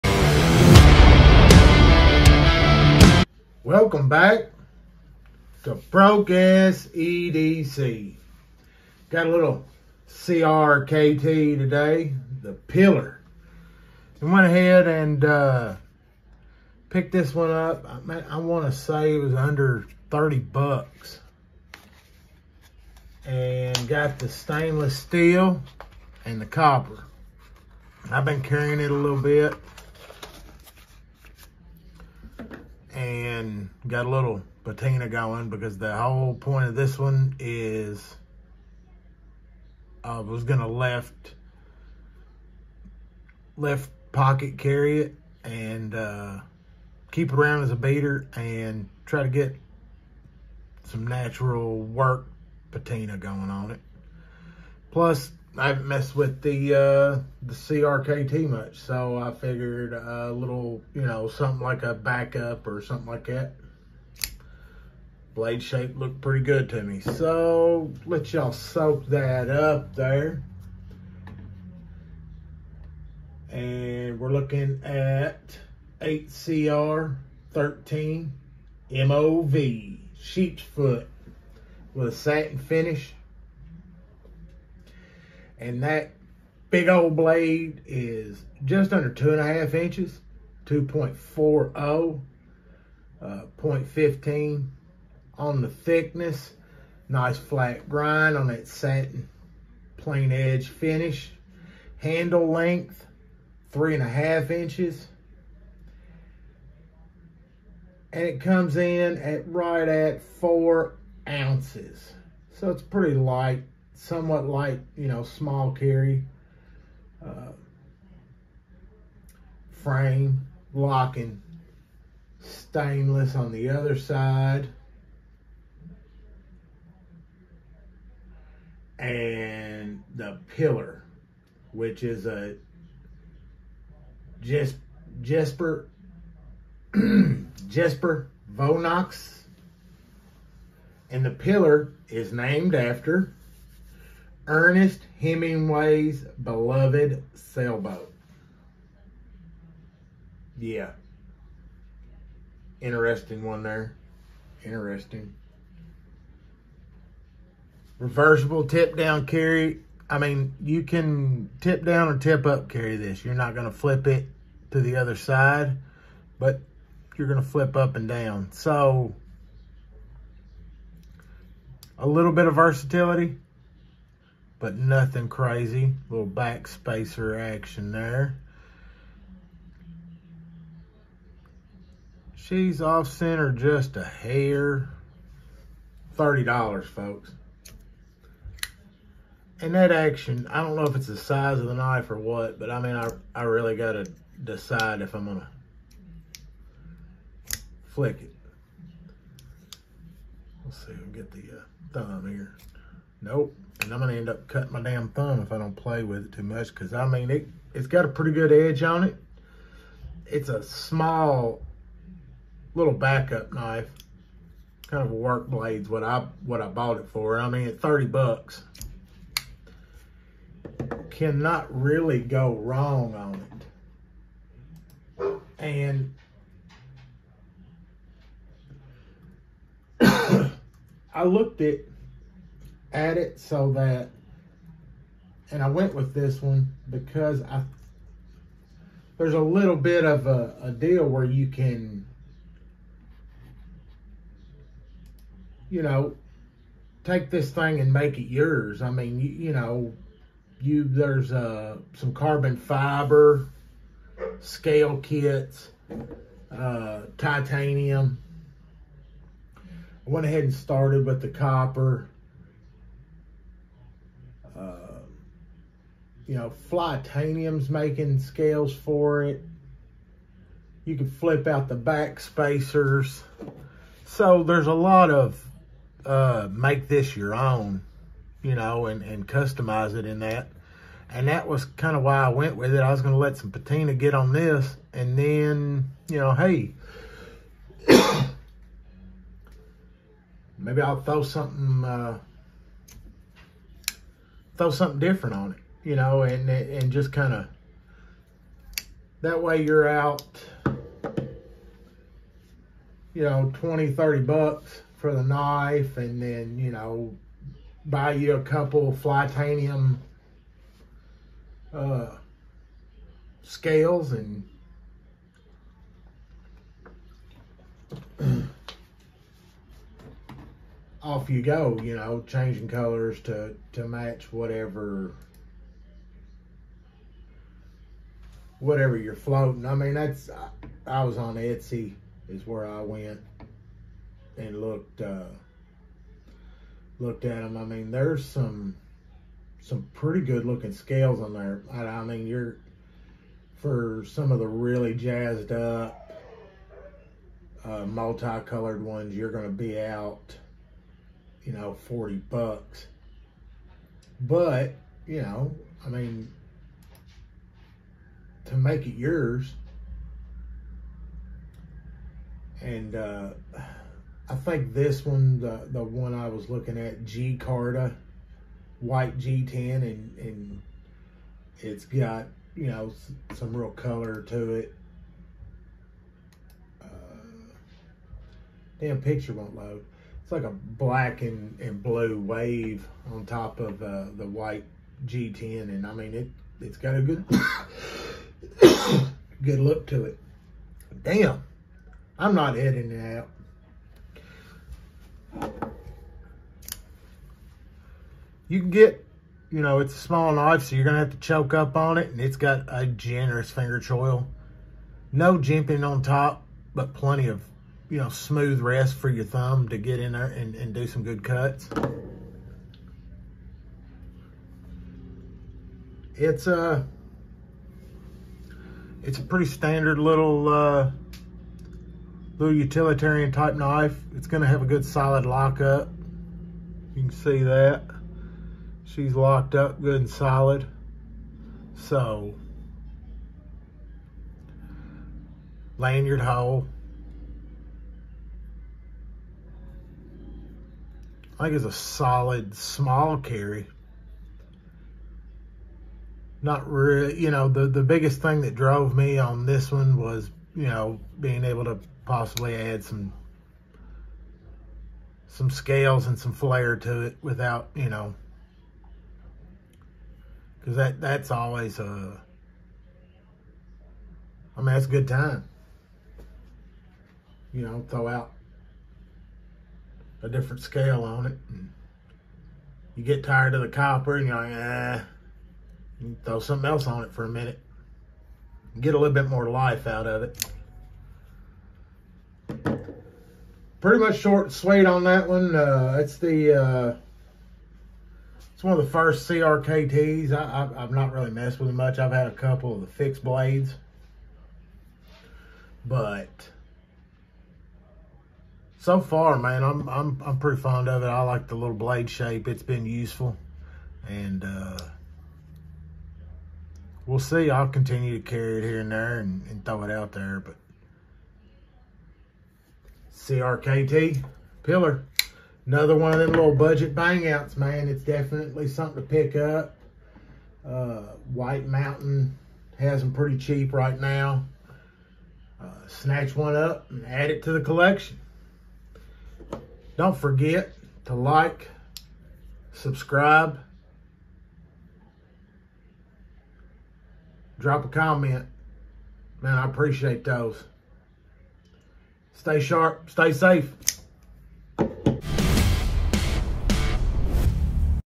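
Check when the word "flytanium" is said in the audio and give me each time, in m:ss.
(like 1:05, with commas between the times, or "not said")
4:26, 5:08.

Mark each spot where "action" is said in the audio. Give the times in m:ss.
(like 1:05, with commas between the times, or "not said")
2:57, 3:09.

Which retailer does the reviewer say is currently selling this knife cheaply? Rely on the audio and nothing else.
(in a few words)
White Mountain.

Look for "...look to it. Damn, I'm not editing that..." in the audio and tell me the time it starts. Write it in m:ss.
6:29.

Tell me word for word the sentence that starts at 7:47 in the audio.
You know, throw out a different scale on it.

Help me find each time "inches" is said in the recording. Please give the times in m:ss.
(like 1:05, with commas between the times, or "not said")
1:29, 1:44.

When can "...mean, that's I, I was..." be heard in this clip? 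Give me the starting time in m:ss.
5:29.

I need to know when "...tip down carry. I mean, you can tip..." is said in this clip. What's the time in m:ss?
2:38.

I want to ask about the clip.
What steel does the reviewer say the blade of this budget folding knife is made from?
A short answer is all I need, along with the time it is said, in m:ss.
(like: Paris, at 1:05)
8CR13MOV, at 1:16.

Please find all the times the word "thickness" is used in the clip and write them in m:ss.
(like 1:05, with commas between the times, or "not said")
1:35.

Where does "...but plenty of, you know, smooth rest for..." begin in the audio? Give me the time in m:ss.
6:46.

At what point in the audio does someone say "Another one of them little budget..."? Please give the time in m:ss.
8:35.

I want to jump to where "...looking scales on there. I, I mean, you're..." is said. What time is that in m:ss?
5:40.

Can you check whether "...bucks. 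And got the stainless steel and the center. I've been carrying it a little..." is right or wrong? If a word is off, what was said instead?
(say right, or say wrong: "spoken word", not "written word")
wrong: "copper", not "center".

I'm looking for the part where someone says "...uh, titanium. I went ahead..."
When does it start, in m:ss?
4:16.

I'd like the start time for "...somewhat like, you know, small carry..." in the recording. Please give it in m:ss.
1:54.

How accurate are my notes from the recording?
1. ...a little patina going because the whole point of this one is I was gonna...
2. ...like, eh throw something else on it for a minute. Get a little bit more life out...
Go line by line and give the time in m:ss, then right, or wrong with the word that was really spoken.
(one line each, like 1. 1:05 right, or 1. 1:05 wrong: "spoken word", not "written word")
1. 0:34 right
2. 7:54 right.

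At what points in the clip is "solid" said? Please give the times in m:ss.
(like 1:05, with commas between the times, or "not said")
7:04, 7:10, 7:21.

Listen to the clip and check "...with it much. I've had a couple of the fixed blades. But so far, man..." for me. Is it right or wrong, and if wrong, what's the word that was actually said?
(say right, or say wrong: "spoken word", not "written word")
right.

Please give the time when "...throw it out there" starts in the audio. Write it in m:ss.
8:29.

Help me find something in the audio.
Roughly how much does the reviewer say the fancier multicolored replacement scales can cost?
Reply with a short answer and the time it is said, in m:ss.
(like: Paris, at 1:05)
$40, at 5:51.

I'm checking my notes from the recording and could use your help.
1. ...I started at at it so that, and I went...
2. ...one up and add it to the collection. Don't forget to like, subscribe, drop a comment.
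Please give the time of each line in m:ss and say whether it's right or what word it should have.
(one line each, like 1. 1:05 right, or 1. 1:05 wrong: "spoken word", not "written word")
1. 3:51 wrong: "looked", not "started"
2. 8:46 right.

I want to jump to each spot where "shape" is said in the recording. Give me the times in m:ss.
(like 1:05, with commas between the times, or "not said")
1:05, 8:22.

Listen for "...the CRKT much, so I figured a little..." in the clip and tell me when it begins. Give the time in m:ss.
0:57.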